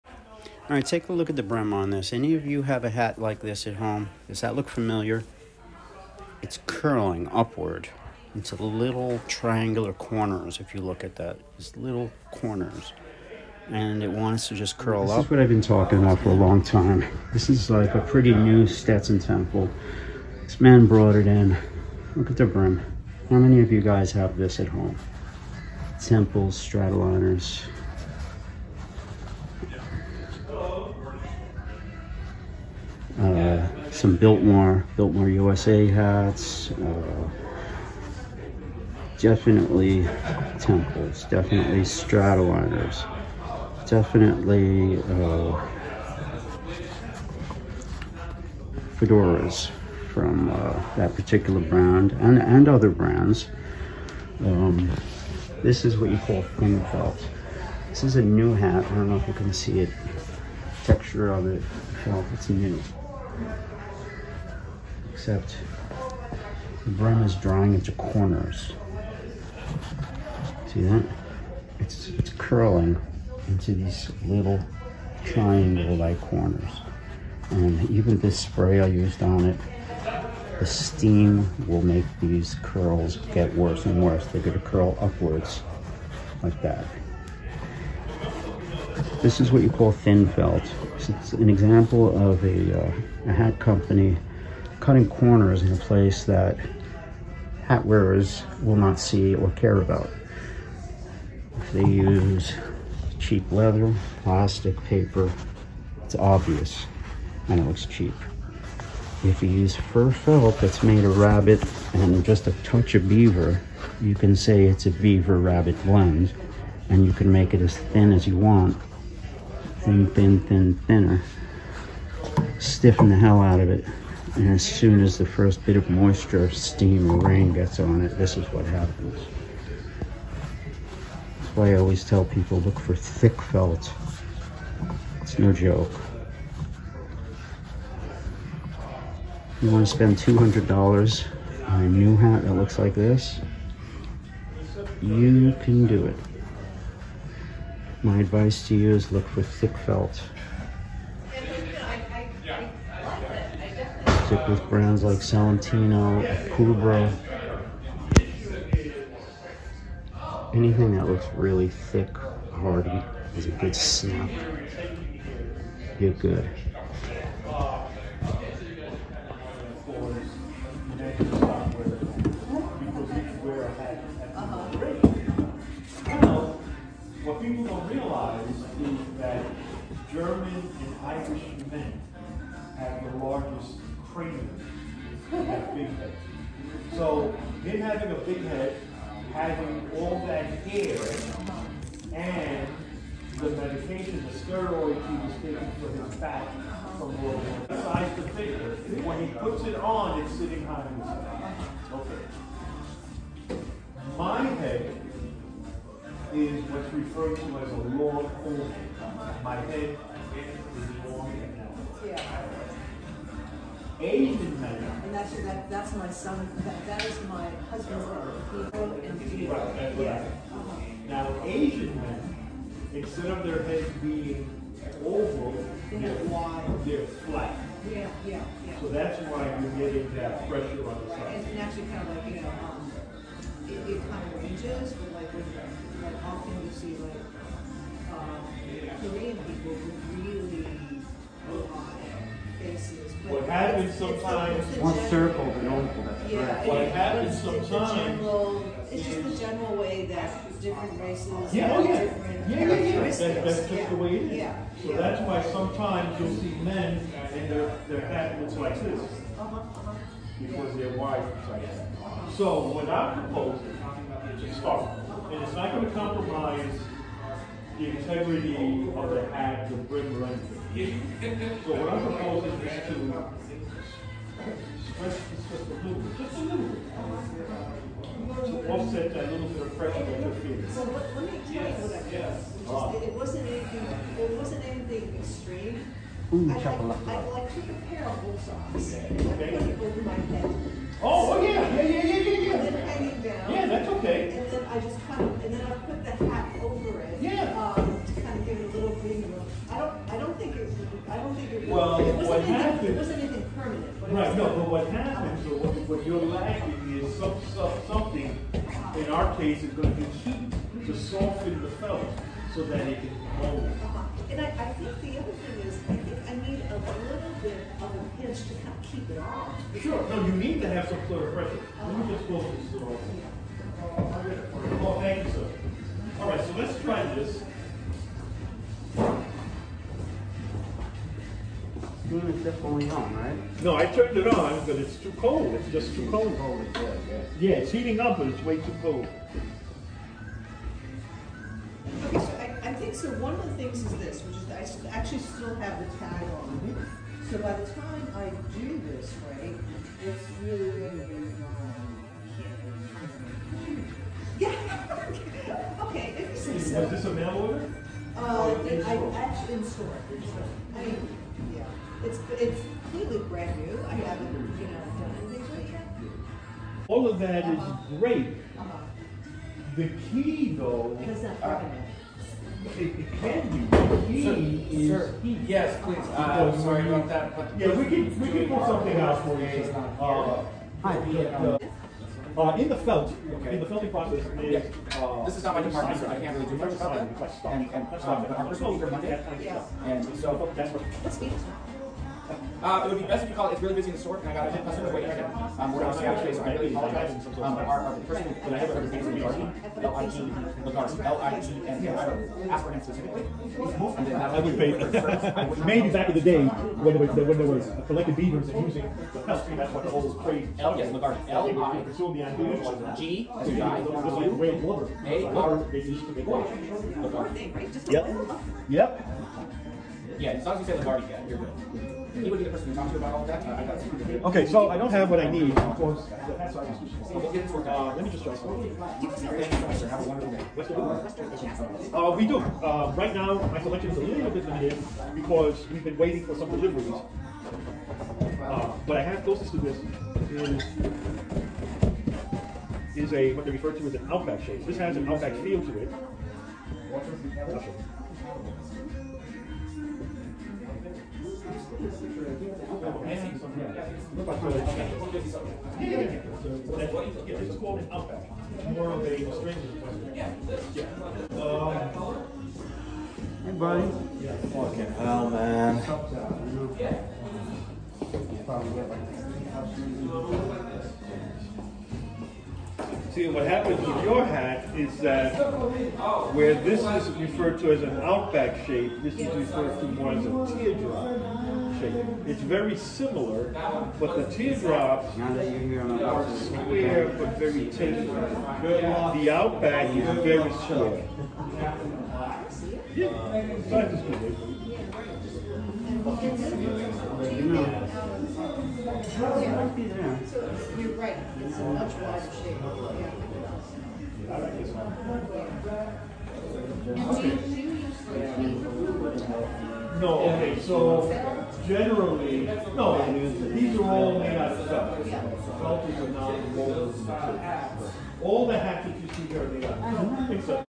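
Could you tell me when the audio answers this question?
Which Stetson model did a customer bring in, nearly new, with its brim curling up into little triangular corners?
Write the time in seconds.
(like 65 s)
18 s.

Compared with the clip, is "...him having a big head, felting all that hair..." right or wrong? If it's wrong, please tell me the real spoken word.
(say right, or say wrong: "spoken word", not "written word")
wrong: "having", not "felting".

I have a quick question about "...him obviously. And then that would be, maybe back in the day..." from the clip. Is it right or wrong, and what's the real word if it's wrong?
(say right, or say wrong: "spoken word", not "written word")
wrong: "specifically", not "obviously".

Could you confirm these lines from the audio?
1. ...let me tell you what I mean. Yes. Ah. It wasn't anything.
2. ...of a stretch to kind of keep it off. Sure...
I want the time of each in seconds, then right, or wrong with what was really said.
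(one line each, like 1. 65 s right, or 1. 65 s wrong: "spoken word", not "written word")
1. 281 s right
2. 317 s wrong: "pinch", not "stretch".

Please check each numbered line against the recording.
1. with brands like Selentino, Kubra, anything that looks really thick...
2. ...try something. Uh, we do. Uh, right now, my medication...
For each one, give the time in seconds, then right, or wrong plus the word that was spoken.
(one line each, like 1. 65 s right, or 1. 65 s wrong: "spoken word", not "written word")
1. 154 s right
2. 428 s wrong: "selection", not "medication".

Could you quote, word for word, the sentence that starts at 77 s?
And even this spray I used on it, the steam will make these curls get worse and worse.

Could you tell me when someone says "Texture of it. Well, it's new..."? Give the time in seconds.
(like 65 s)
60 s.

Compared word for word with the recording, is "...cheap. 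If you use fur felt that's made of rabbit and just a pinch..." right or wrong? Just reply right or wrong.
wrong.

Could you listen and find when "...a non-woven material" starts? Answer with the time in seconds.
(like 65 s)
515 s.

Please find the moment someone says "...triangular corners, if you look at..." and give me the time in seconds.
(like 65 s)
9 s.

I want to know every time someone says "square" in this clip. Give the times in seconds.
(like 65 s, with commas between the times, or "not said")
486 s, 490 s.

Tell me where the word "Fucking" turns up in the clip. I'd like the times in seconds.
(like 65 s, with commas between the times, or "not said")
464 s.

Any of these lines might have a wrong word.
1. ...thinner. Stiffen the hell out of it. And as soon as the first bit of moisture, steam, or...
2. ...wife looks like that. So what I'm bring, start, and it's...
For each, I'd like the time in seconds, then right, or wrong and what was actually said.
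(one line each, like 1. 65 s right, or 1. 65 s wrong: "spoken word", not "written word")
1. 120 s right
2. 260 s wrong: "proposing", not "bring".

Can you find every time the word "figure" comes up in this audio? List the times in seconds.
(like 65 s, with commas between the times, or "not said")
198 s.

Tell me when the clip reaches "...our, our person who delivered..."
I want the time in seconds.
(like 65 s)
397 s.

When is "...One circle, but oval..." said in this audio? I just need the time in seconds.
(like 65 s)
244 s.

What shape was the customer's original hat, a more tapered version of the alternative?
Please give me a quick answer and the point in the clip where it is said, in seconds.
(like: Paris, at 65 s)
teardrop, at 480 s.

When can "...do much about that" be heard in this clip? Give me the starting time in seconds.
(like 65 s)
386 s.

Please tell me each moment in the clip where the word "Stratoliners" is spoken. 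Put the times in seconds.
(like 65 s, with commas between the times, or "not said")
26 s, 41 s.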